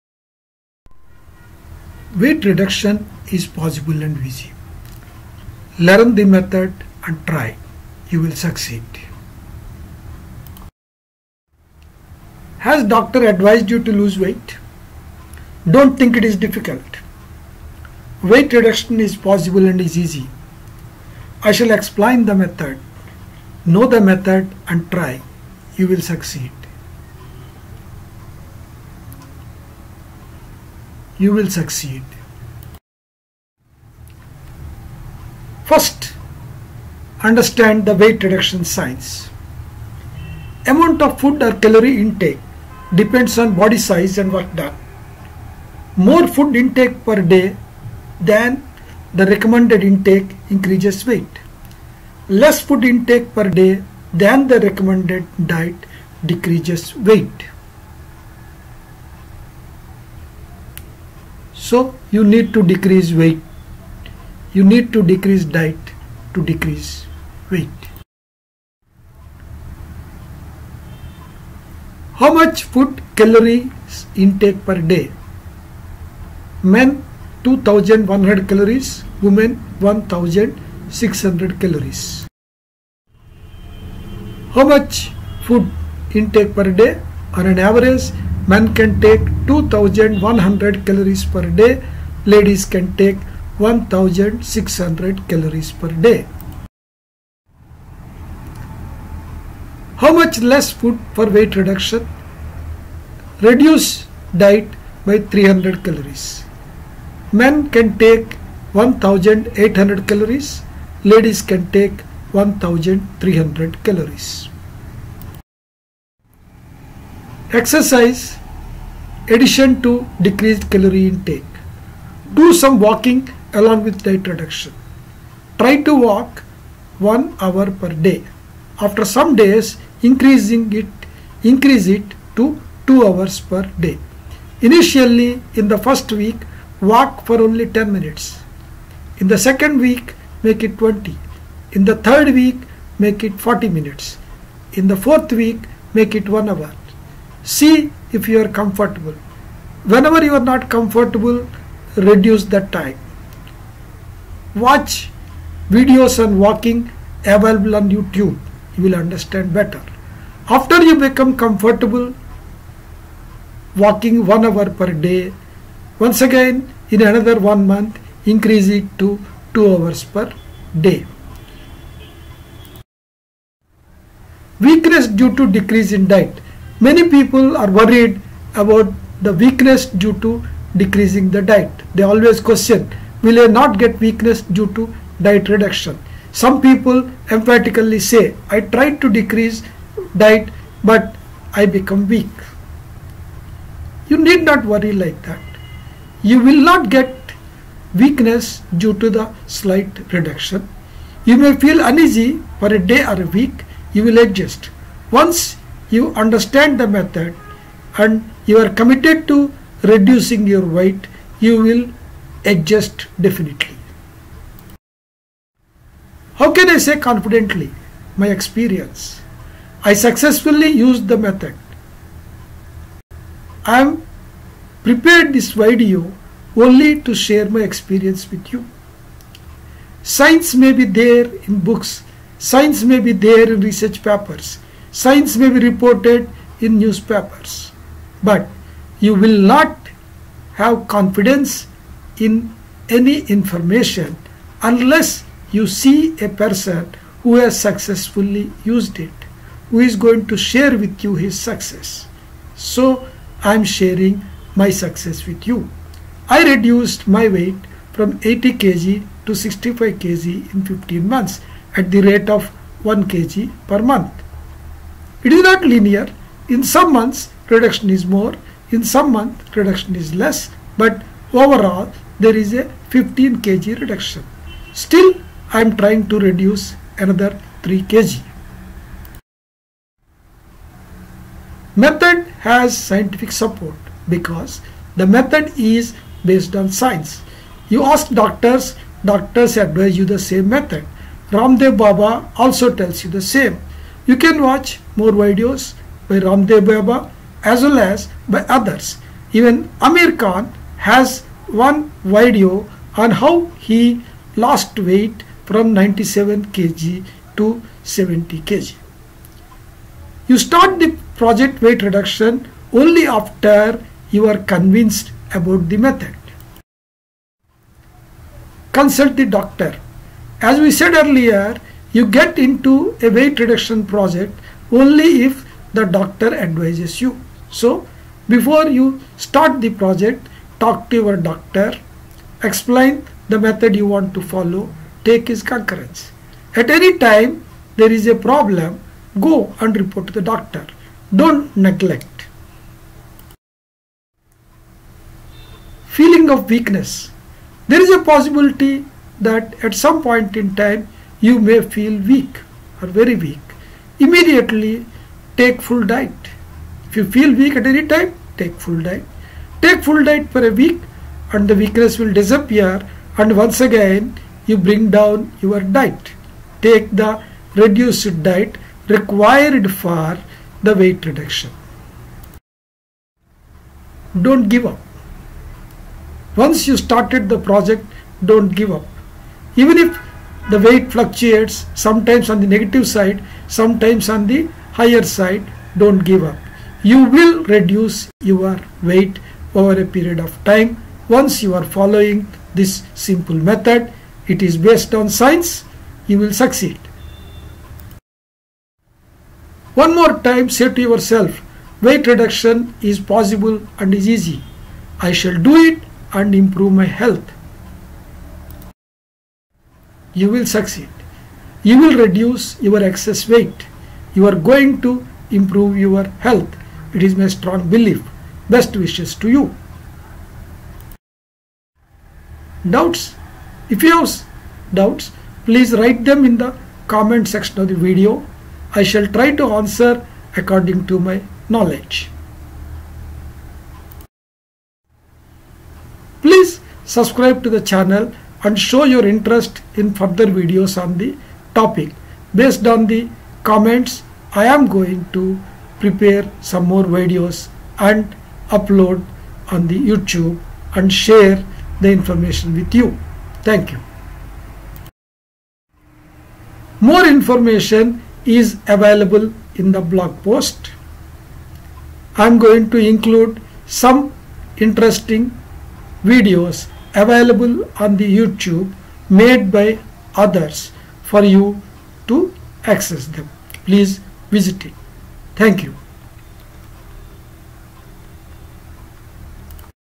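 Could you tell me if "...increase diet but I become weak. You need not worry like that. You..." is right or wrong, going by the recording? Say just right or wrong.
wrong.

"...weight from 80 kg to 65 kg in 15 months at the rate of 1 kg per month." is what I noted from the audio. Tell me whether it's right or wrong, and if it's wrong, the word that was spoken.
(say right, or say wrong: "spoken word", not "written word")
right.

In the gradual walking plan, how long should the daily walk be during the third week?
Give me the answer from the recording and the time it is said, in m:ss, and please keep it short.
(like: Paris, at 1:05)
40 minutes, at 2:23.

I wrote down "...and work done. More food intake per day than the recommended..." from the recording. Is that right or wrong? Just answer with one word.
right.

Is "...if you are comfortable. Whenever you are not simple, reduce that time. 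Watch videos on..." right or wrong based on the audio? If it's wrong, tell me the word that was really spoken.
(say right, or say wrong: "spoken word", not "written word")
wrong: "comfortable", not "simple".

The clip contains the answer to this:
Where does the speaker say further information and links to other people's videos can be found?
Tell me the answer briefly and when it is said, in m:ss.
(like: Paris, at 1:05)
blog post, at 7:39.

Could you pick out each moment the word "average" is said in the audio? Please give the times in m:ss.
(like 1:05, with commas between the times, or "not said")
1:27.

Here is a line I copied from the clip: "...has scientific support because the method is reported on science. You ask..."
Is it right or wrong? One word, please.
wrong.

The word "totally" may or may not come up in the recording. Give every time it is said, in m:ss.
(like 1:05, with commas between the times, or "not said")
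not said.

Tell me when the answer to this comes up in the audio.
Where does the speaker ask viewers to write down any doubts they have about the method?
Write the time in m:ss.
7:06.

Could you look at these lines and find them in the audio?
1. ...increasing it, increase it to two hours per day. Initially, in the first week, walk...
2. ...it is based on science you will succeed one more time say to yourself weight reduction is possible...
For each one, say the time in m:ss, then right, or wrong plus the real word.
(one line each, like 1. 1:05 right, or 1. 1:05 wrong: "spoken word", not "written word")
1. 2:10 right
2. 6:34 right.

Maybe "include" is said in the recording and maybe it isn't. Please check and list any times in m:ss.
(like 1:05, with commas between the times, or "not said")
7:42.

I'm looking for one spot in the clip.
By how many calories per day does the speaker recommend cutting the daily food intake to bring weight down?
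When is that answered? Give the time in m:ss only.
1:45.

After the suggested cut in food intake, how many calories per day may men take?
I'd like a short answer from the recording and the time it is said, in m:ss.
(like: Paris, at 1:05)
1800, at 1:48.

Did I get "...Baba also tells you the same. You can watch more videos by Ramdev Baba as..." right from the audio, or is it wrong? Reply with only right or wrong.
right.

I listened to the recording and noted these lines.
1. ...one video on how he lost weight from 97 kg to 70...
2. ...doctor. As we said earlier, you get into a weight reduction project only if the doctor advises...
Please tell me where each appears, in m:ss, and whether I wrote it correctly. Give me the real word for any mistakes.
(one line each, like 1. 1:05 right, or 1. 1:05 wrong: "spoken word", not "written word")
1. 5:01 right
2. 5:19 right.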